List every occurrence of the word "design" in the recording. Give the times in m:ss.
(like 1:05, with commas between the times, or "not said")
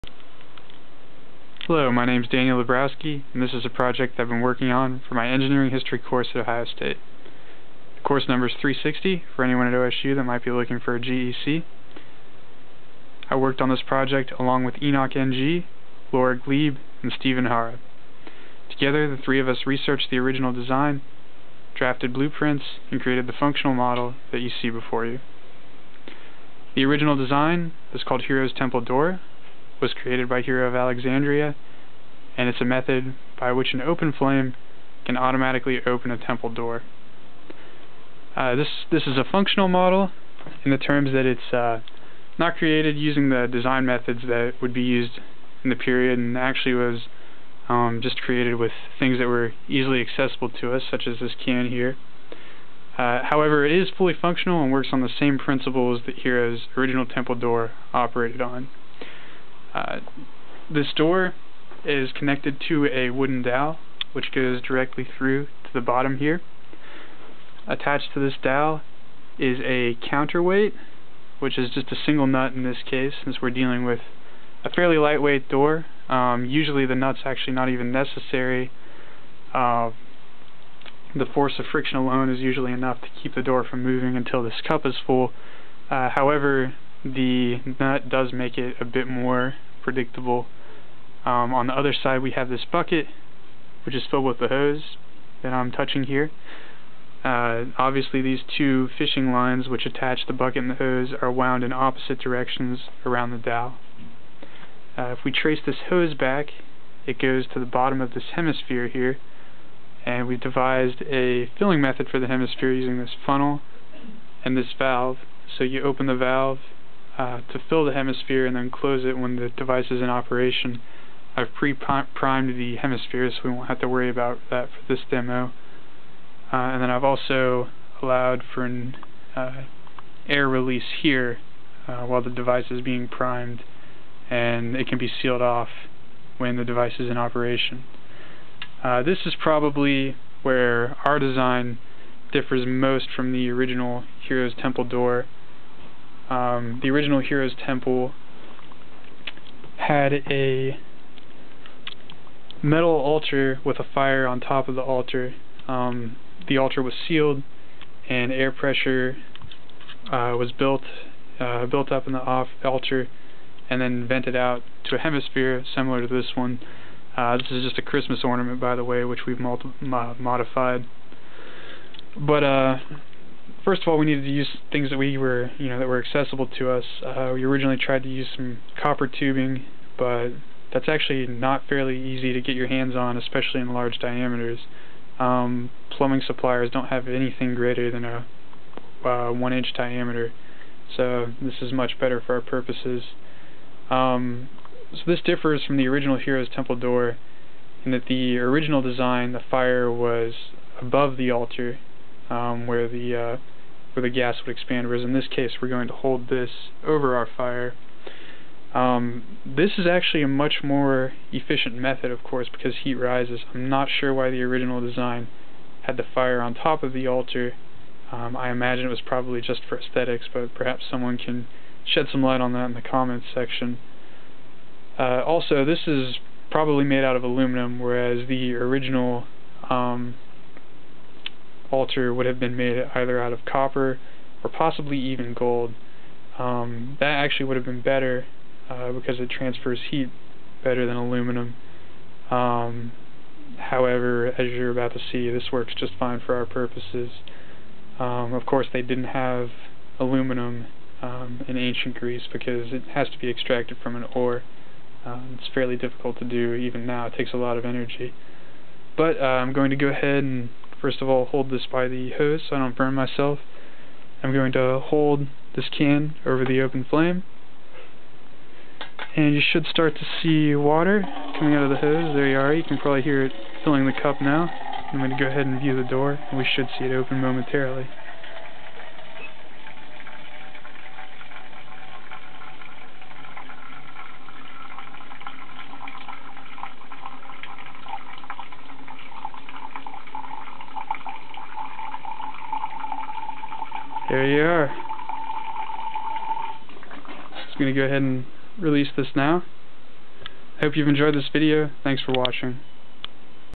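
0:20, 0:27, 0:43, 2:21, 3:18, 3:34.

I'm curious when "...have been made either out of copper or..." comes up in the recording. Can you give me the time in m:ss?
3:52.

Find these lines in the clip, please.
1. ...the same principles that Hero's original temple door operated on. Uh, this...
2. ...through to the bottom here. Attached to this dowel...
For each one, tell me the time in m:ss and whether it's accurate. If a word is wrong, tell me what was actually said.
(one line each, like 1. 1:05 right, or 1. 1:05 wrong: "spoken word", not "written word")
1. 0:55 right
2. 1:05 right.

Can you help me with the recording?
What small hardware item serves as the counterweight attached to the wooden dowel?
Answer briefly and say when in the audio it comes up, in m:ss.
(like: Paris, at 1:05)
A single nut, at 1:11.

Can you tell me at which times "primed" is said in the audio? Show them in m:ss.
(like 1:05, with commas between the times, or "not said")
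2:01, 2:13.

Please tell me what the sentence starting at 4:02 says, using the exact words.
Um, however, as you're about to see, this works just fine for our purposes.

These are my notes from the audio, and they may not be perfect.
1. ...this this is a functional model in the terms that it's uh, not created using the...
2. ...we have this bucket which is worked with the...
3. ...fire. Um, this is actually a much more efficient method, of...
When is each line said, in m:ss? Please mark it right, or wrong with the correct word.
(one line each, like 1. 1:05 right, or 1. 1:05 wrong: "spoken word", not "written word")
1. 0:38 right
2. 1:32 wrong: "filled", not "worked"
3. 3:27 right.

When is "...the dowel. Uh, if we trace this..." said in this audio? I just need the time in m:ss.
1:43.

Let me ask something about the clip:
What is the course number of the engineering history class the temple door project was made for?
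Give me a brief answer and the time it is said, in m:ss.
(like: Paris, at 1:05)
360, at 0:08.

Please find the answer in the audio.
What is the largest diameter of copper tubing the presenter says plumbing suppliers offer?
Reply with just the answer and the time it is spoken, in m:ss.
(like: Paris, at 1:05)
One inch, at 3:09.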